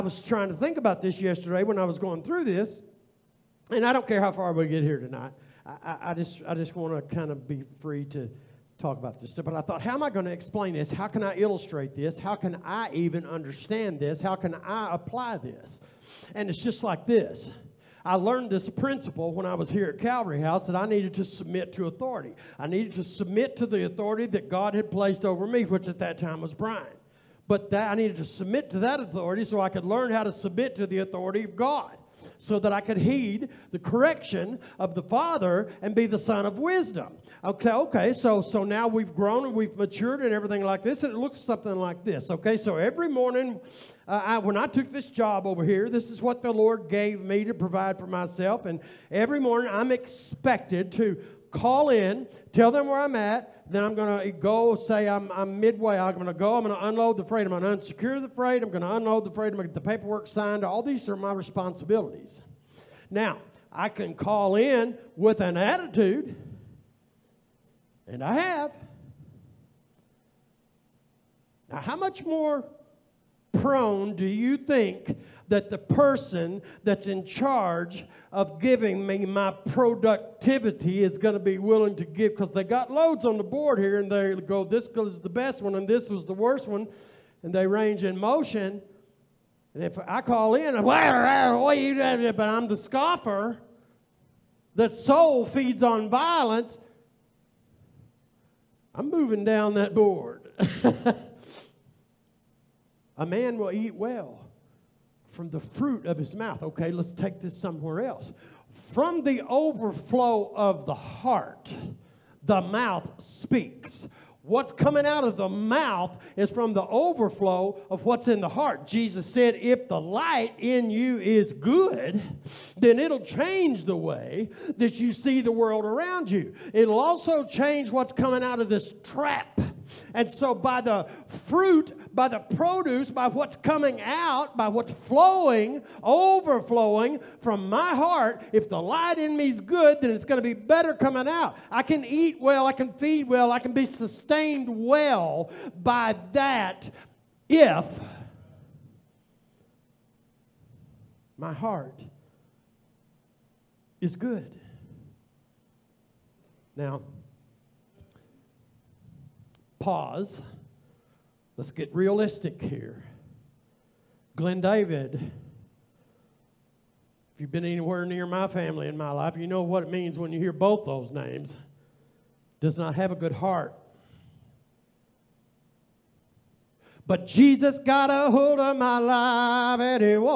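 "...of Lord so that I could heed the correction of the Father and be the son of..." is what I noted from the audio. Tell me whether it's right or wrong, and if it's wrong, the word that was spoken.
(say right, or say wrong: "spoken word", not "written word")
wrong: "God", not "Lord".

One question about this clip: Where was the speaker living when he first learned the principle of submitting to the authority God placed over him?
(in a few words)
Calvary House.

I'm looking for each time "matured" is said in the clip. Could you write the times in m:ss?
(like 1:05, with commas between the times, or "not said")
0:39.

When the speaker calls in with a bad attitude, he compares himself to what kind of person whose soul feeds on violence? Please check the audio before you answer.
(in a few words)
The scoffer.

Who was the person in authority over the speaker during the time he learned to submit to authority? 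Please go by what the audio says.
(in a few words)
Brian.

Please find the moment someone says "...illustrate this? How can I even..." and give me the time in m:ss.
0:11.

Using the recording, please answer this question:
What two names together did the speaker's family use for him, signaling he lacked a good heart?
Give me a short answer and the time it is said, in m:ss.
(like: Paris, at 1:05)
Glenn David, at 2:44.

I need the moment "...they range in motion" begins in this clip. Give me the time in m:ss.
1:27.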